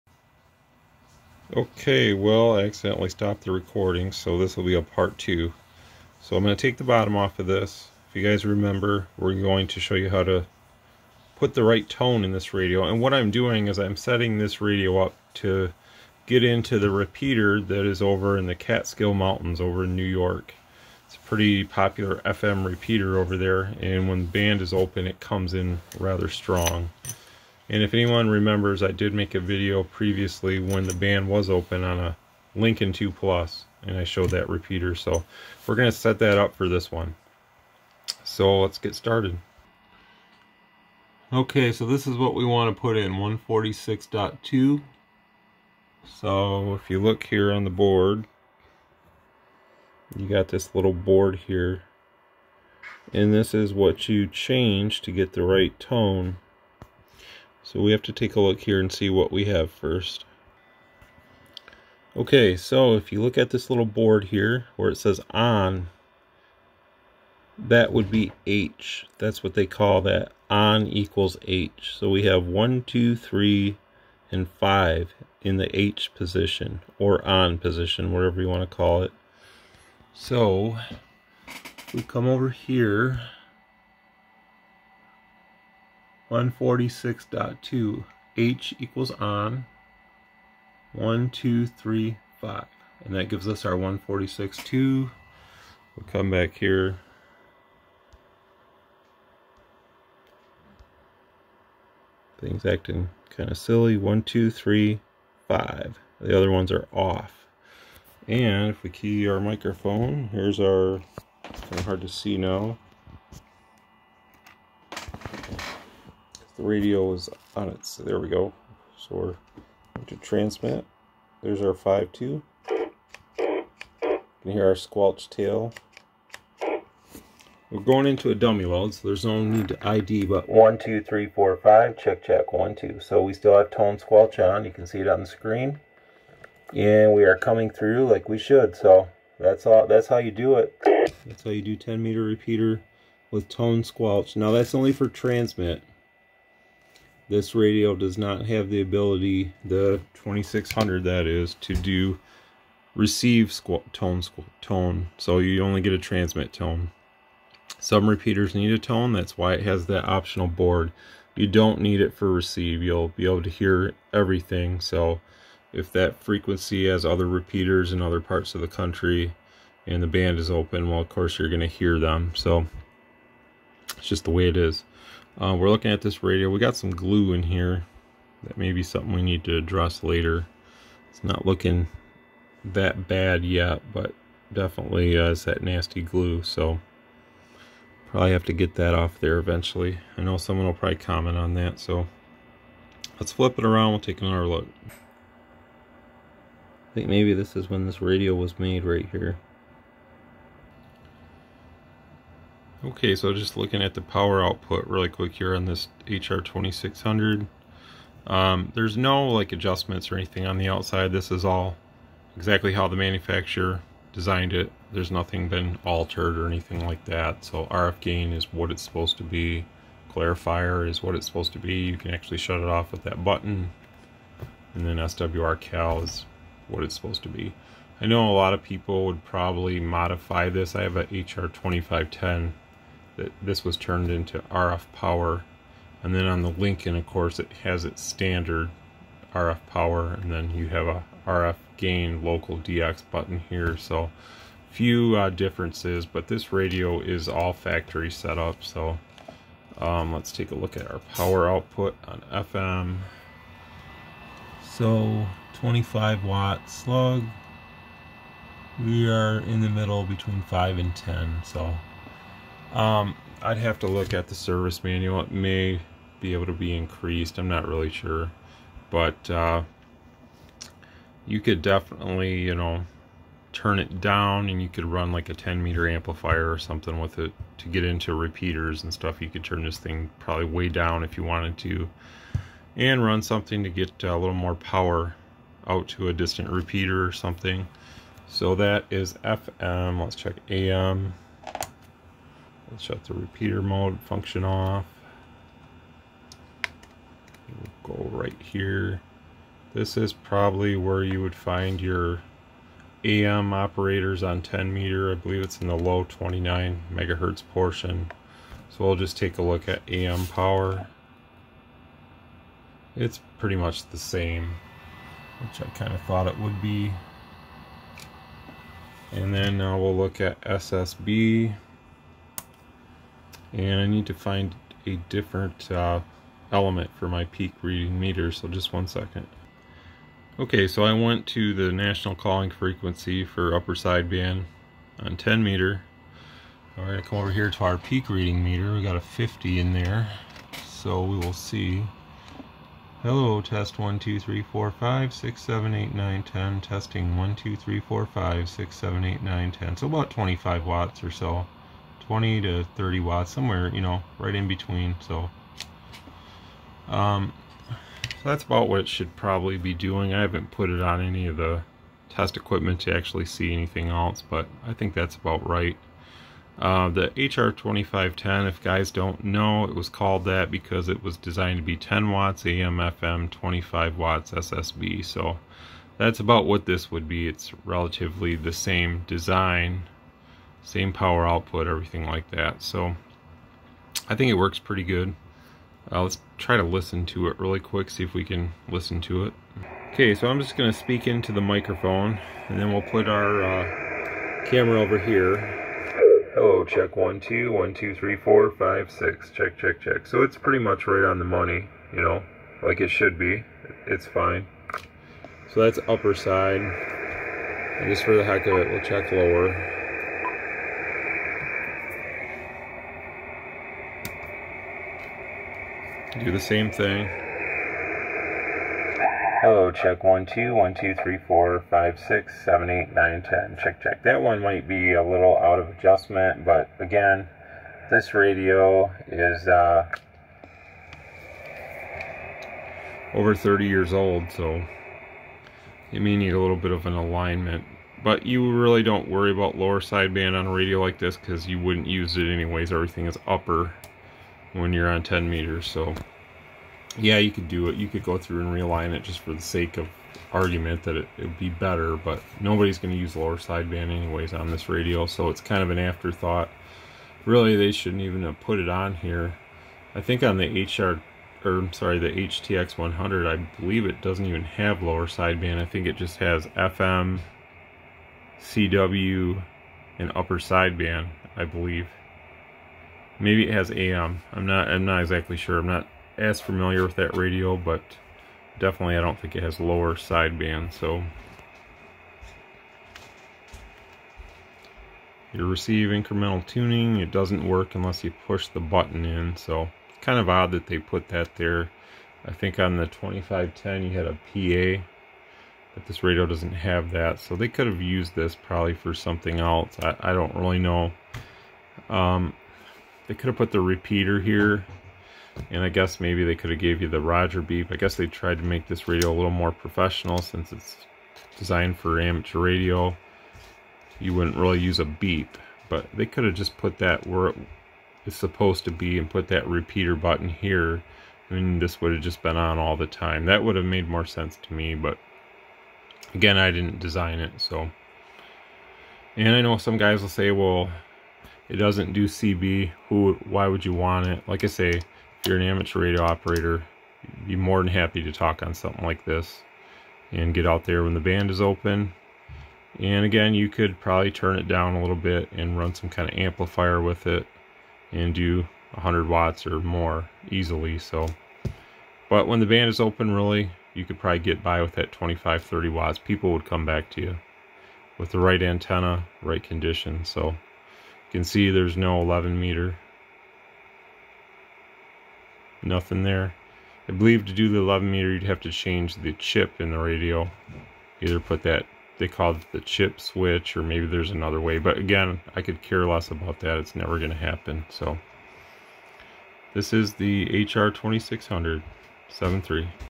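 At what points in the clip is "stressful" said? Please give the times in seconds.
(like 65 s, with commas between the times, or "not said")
not said.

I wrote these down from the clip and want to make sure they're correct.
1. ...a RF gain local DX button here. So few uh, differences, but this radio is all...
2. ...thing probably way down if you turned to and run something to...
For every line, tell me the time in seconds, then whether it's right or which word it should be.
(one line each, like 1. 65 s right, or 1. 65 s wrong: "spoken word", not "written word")
1. 240 s right
2. 279 s wrong: "wanted", not "turned".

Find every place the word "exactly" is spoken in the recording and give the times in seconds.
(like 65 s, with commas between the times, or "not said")
212 s, 475 s.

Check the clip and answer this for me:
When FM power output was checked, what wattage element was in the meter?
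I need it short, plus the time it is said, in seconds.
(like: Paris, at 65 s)
25 watt, at 255 s.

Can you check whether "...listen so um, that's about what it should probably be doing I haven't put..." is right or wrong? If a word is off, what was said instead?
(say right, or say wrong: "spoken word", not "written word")
wrong: "between", not "listen".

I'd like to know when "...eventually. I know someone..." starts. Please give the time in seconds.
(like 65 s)
189 s.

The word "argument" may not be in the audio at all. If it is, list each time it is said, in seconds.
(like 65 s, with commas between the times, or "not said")
450 s.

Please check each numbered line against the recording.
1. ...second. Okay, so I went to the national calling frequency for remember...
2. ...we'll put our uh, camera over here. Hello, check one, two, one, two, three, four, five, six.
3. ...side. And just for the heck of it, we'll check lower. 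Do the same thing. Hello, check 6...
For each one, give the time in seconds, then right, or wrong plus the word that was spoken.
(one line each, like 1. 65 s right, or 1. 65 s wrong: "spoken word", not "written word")
1. 328 s wrong: "upper", not "remember"
2. 392 s right
3. 406 s wrong: "1", not "6".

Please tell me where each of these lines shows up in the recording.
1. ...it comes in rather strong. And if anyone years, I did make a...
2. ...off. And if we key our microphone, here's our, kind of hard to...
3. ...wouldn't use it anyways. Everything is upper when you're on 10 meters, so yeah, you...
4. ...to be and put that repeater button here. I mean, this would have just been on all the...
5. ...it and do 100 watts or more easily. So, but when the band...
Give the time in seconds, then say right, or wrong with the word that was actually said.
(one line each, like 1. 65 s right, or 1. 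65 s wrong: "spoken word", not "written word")
1. 25 s wrong: "remembers", not "years"
2. 106 s right
3. 441 s right
4. 518 s right
5. 547 s right.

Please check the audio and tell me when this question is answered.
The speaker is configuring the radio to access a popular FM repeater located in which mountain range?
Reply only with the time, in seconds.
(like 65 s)
18 s.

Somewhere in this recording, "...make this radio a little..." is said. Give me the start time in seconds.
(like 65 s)
508 s.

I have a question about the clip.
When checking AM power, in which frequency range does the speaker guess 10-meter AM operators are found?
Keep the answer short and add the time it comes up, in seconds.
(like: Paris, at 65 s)
29 megahertz, at 306 s.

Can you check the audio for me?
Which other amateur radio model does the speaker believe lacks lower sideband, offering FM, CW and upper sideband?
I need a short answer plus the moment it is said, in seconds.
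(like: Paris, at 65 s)
HTX 100, at 462 s.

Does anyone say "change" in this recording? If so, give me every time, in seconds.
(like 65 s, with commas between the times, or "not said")
54 s, 568 s.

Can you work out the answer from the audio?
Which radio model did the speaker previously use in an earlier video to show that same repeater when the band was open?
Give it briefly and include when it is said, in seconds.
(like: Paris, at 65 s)
Lincoln 2 Plus, at 32 s.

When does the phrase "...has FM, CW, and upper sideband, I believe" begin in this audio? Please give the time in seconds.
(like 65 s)
466 s.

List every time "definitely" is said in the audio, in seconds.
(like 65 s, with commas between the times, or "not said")
184 s, 271 s, 478 s.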